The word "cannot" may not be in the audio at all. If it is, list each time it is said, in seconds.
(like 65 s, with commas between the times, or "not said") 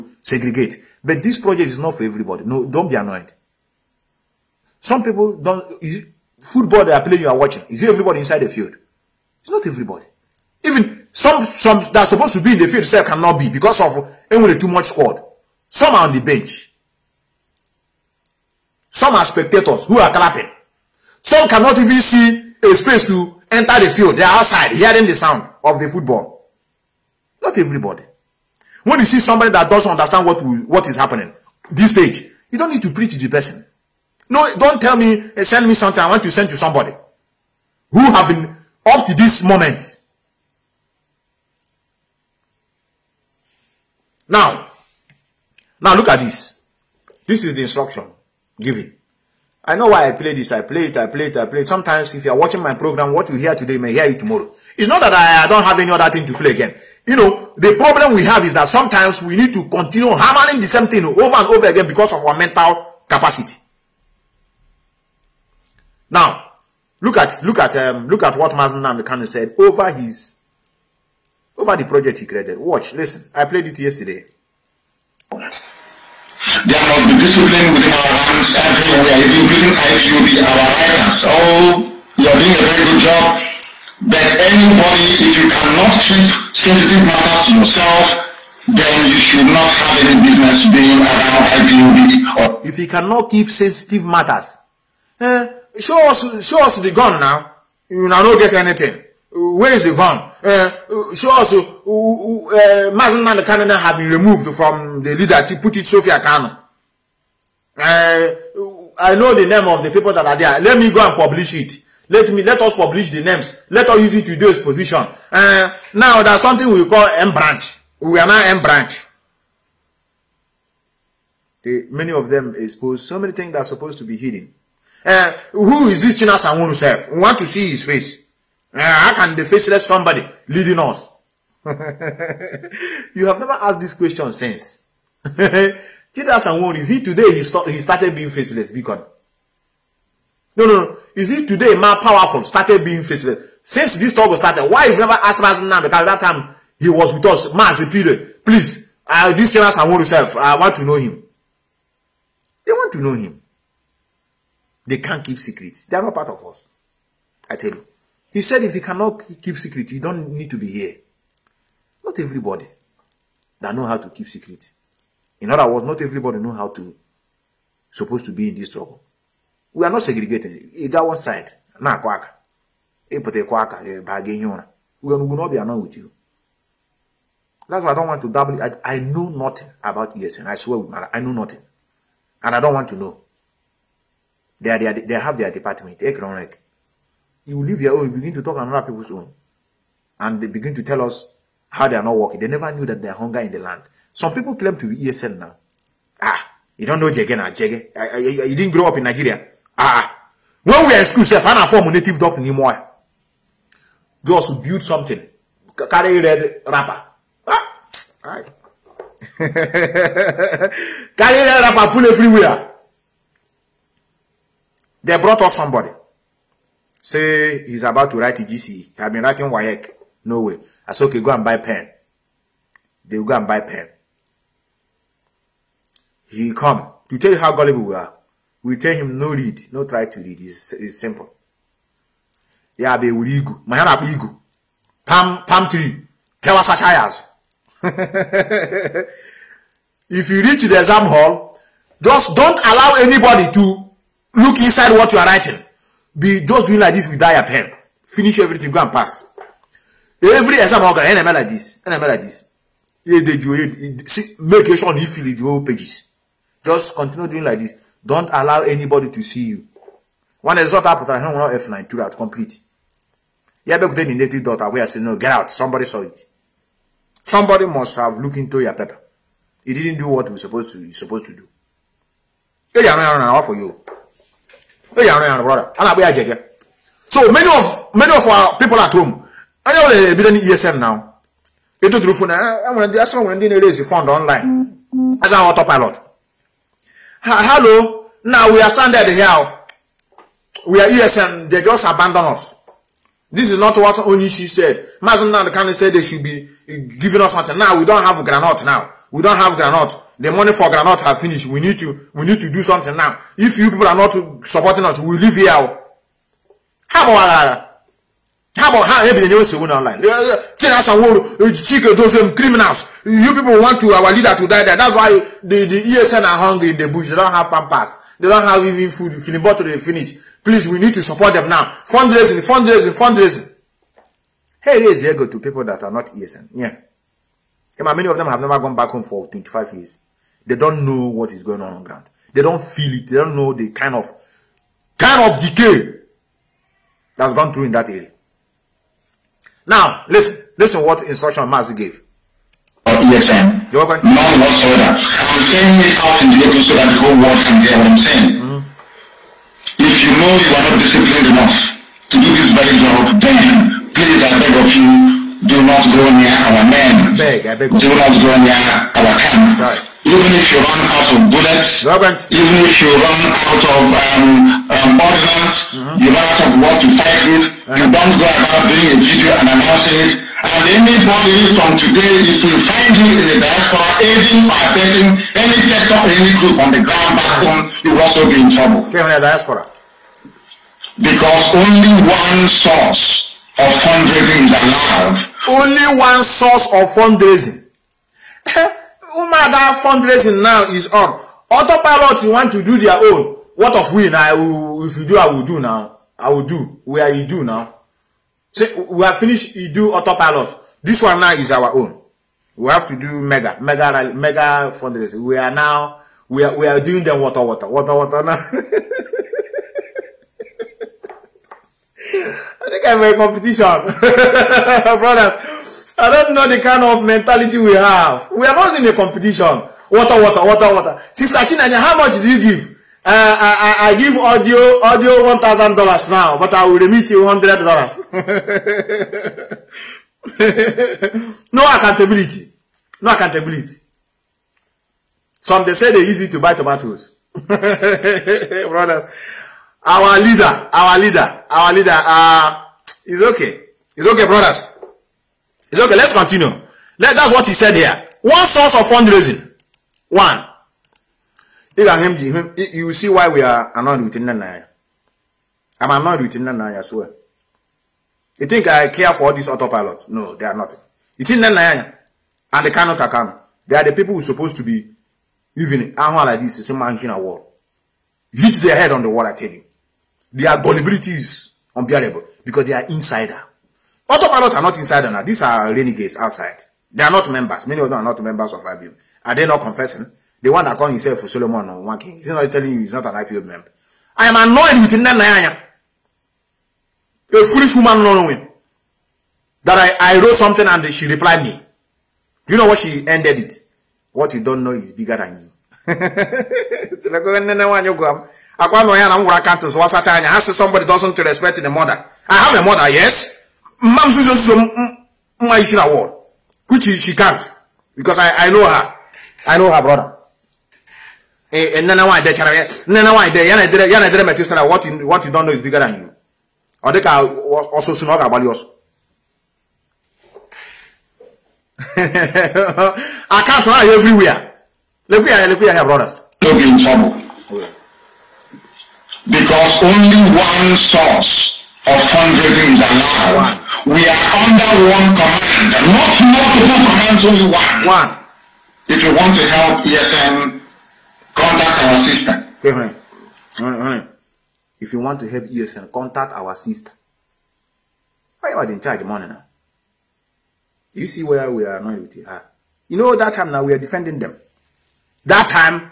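13 s, 21 s, 85 s, 92 s, 158 s, 462 s.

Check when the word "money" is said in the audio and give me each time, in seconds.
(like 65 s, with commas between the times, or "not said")
300 s, 549 s.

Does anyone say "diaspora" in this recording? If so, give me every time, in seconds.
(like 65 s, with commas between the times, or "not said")
373 s, 379 s.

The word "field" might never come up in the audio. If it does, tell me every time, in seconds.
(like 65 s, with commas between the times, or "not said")
8 s, 12 s, 23 s.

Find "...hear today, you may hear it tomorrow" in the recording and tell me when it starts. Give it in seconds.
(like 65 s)
53 s.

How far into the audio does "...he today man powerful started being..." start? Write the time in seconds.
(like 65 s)
141 s.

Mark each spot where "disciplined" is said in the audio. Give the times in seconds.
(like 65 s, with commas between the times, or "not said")
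77 s, 350 s.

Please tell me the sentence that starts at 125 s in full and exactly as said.
Uh, who is this China Sangwon himself?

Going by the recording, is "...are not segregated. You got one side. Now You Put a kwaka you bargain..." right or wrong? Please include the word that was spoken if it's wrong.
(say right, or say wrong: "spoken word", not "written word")
right.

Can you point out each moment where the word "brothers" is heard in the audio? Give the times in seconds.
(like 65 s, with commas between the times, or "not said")
275 s, 414 s, 438 s, 444 s, 509 s, 525 s.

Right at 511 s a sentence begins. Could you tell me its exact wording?
And then I did Nana why they yana did yana did metis what you what you don't know is bigger than you.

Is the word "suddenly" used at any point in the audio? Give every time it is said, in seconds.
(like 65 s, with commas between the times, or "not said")
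not said.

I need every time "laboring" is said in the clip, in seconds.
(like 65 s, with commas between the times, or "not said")
not said.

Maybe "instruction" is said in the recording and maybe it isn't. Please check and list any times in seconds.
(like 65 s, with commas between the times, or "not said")
47 s, 341 s.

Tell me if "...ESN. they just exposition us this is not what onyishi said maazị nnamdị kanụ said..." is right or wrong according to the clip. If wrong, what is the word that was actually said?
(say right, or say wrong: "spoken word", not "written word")
wrong: "abandon", not "exposition".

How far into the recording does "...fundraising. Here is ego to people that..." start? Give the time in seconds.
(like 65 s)
322 s.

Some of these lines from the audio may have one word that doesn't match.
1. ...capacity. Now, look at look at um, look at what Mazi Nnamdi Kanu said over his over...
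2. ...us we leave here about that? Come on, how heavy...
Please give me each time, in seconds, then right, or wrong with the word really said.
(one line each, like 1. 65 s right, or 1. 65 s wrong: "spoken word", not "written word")
1. 63 s right
2. 304 s right.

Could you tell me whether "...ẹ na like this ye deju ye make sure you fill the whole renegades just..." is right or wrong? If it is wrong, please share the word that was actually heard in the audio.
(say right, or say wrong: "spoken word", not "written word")
wrong: "pages", not "renegades".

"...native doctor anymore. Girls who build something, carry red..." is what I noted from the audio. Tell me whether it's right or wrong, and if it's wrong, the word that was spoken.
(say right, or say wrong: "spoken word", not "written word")
right.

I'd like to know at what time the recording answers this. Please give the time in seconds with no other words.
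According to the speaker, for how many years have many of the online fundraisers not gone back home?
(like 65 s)
329 s.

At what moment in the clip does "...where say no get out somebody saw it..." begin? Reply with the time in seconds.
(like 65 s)
264 s.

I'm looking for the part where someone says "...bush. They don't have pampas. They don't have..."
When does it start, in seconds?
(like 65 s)
316 s.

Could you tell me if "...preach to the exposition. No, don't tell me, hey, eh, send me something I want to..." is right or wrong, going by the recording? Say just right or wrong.
wrong.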